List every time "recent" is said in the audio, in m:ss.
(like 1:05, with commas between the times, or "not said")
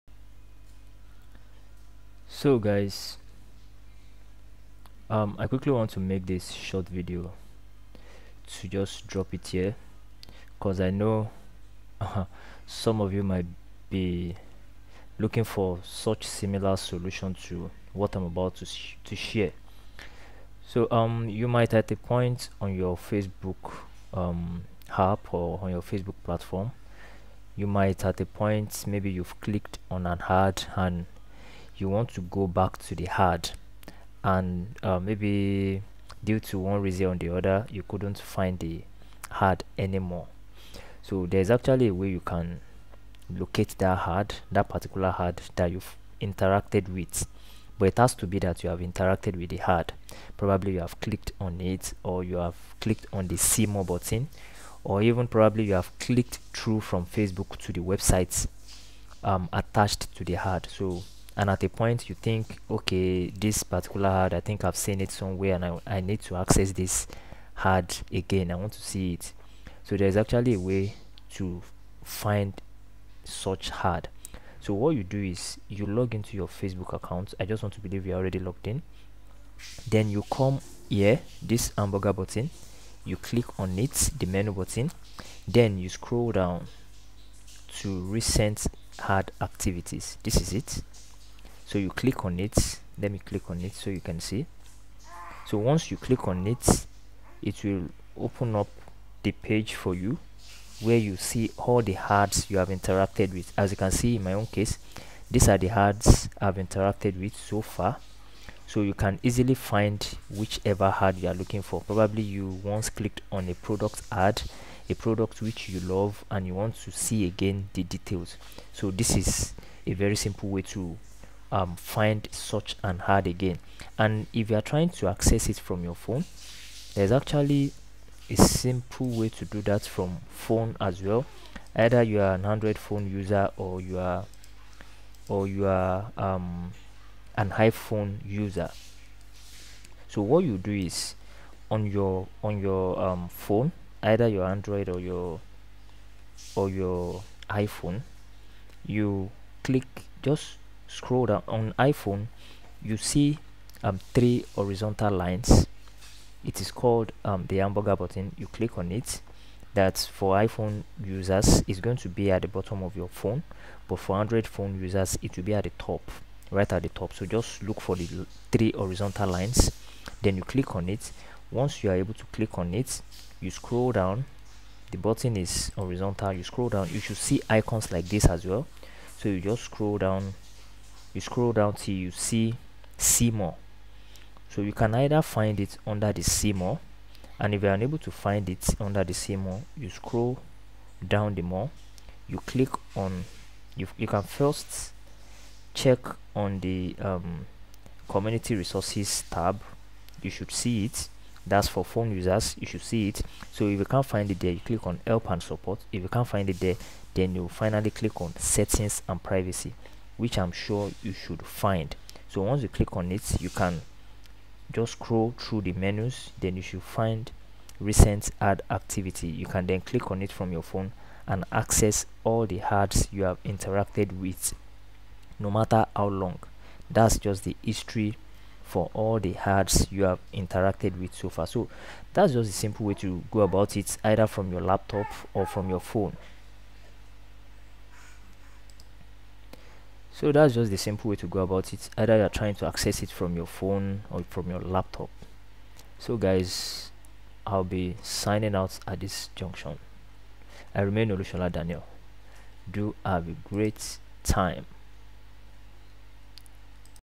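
1:28, 3:37.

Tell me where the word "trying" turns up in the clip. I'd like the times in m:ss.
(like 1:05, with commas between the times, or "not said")
2:04, 4:02.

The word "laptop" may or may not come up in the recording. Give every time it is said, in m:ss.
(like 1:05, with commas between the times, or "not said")
3:54, 4:04.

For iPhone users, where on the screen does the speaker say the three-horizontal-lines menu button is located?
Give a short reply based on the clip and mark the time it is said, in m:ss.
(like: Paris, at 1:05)
At the bottom, at 2:42.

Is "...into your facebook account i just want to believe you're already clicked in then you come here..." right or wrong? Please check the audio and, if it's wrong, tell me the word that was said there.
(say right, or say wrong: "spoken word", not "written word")
wrong: "logged", not "clicked".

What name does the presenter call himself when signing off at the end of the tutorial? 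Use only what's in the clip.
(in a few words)
Olusola Daniel.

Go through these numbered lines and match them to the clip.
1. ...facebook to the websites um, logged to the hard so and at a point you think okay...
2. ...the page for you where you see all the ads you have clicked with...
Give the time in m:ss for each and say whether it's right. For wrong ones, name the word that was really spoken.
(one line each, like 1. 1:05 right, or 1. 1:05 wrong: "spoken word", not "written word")
1. 0:57 wrong: "attached", not "logged"
2. 1:39 wrong: "interacted", not "clicked".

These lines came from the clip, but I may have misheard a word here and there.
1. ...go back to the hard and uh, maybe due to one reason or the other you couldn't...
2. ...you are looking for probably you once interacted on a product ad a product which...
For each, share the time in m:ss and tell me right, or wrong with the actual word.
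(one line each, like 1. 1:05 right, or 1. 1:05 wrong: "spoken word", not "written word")
1. 0:32 right
2. 1:51 wrong: "clicked", not "interacted".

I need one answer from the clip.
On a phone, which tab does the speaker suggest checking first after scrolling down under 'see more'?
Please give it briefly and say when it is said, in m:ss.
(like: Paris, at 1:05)
Community resources, at 3:18.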